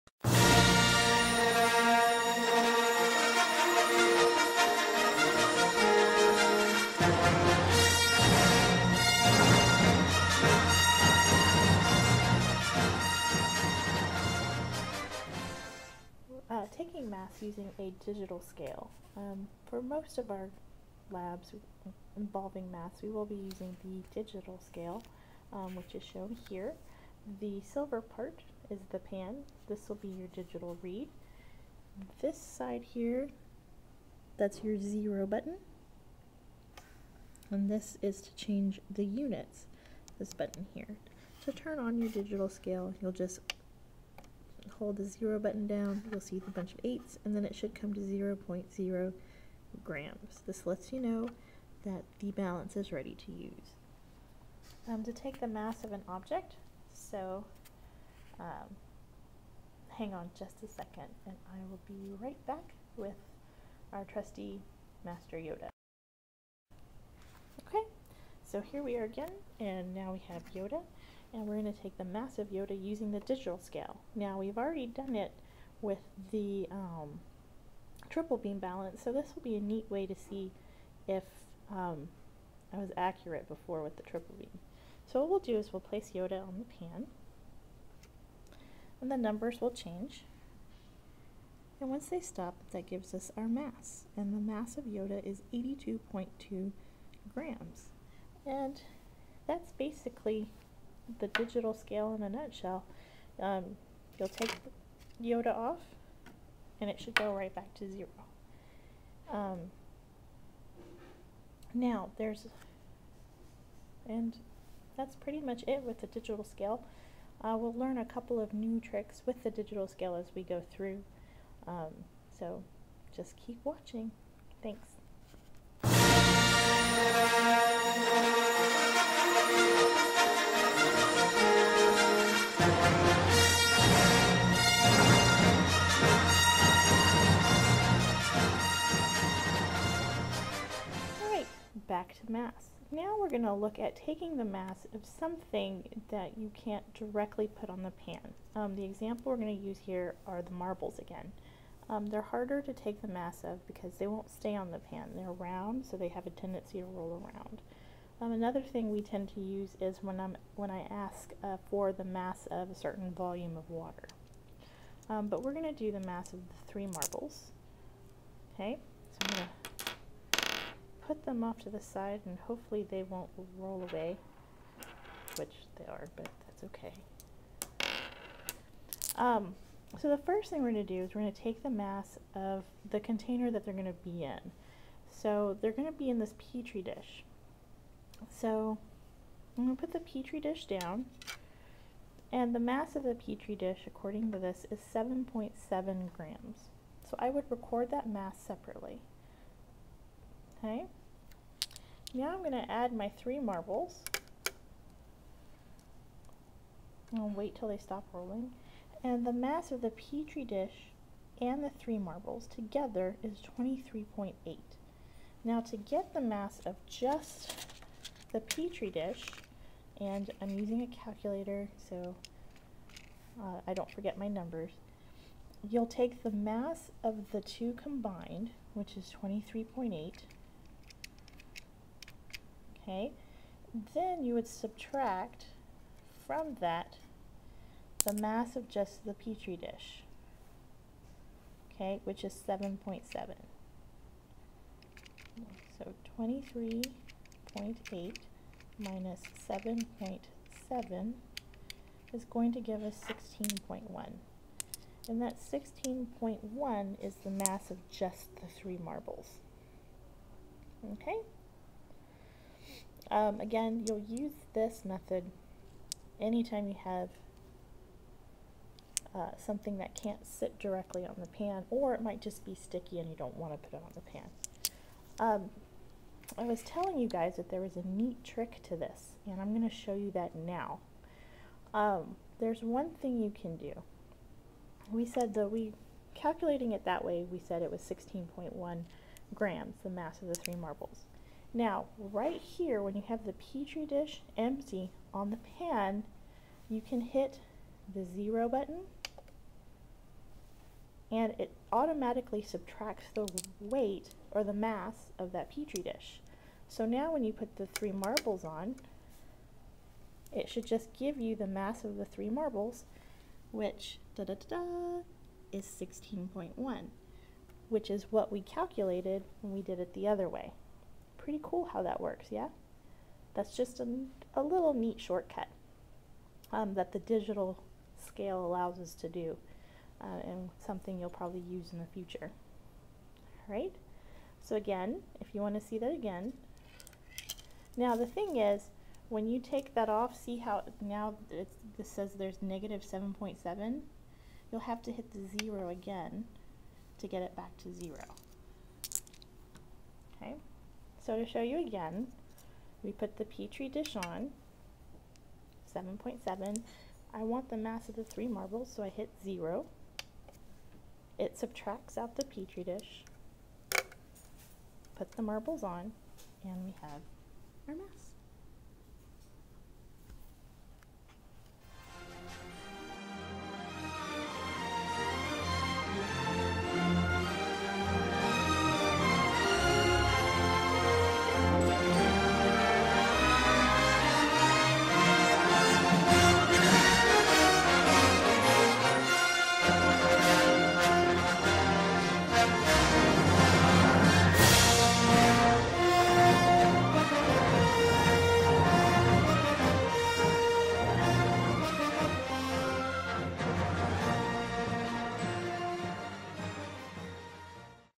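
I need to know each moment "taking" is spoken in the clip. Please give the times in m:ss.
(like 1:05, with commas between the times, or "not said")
0:16, 2:23.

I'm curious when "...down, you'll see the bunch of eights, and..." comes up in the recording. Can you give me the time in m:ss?
0:45.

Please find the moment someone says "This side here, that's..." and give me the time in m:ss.
0:32.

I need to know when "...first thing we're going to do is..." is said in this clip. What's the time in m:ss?
3:00.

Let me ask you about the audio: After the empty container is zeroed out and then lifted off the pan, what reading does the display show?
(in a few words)
-7.7.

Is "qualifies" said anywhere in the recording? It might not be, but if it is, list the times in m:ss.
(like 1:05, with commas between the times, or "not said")
not said.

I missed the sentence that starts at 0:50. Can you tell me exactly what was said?
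This lets you know that the balance is ready to use.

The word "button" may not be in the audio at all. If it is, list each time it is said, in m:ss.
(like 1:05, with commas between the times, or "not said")
0:35, 0:40, 0:45, 4:58.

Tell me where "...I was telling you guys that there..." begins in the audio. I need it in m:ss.
4:36.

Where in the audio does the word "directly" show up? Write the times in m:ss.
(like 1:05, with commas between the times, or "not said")
2:26, 4:30.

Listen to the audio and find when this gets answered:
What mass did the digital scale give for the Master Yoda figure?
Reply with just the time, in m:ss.
1:35.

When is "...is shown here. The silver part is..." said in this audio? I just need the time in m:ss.
0:25.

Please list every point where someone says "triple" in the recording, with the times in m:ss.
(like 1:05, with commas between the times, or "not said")
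1:18, 1:24.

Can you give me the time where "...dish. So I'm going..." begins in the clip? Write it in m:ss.
3:06.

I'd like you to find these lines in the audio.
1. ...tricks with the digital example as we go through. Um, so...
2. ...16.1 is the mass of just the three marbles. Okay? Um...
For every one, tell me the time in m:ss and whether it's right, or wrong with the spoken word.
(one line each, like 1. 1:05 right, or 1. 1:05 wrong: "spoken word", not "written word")
1. 1:58 wrong: "scale", not "example"
2. 4:15 right.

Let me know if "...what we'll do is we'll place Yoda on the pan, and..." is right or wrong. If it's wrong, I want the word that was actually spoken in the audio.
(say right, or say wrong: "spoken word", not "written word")
right.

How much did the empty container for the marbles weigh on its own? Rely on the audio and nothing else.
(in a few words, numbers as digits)
7.7 grams.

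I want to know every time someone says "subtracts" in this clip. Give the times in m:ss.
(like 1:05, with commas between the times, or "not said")
3:54, 5:02, 6:01.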